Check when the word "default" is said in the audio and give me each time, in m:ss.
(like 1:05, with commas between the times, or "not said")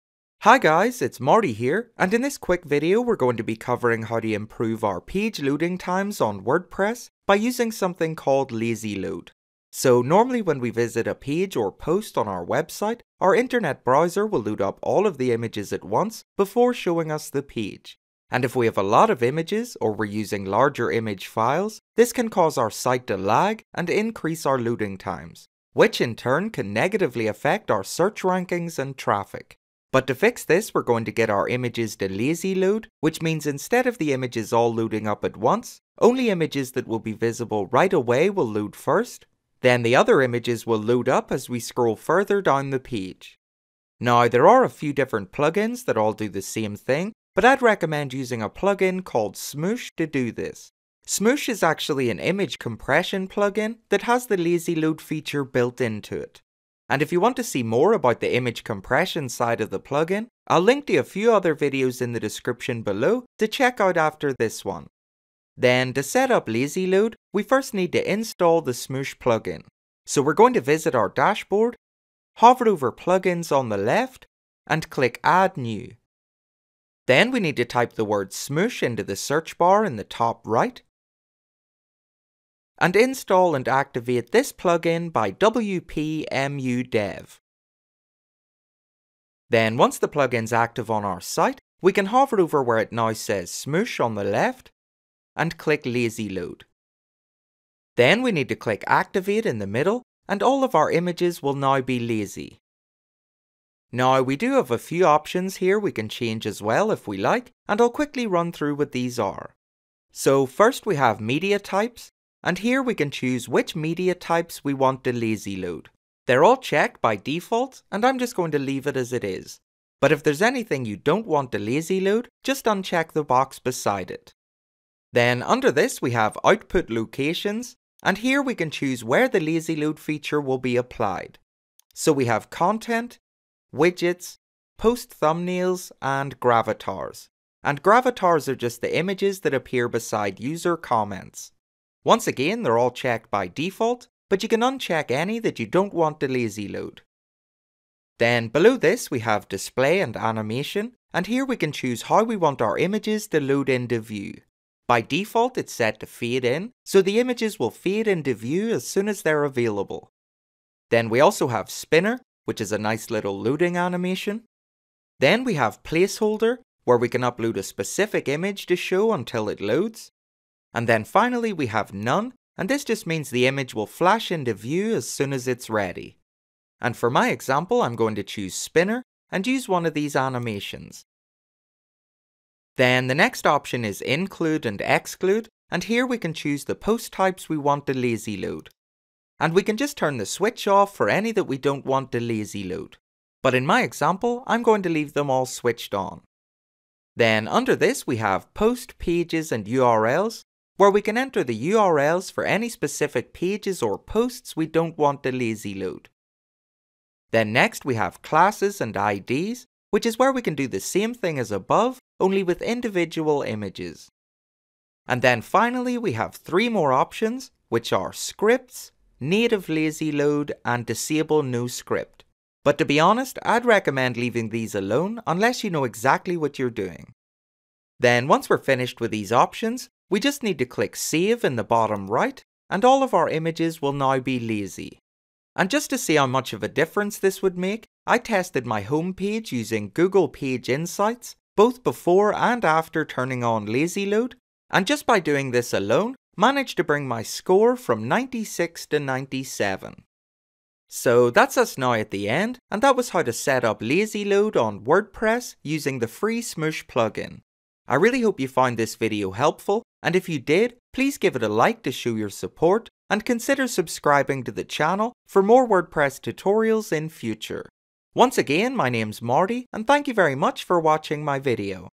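1:57, 2:23, 2:35.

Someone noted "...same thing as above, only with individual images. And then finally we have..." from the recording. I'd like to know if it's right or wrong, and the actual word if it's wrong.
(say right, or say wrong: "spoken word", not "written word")
right.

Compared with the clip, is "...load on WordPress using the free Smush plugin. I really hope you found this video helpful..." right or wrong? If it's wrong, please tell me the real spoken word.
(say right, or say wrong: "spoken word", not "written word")
right.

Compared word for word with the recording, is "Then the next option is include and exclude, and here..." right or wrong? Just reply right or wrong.
right.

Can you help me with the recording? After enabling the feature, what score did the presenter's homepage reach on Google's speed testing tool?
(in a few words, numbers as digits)
97.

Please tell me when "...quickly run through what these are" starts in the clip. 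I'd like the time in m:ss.
1:47.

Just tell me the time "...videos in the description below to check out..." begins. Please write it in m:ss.
1:01.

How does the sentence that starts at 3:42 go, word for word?
But to be honest, I'd recommend leaving these alone unless you know exactly what you're doing.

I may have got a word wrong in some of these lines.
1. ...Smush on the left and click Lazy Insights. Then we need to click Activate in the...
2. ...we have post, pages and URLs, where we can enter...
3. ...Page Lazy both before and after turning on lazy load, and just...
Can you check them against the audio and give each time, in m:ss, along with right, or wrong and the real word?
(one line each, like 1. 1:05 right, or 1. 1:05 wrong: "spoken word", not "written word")
1. 1:33 wrong: "Load", not "Insights"
2. 3:18 right
3. 4:00 wrong: "Insights", not "Lazy".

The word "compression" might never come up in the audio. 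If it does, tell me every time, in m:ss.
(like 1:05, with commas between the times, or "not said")
0:52, 0:58.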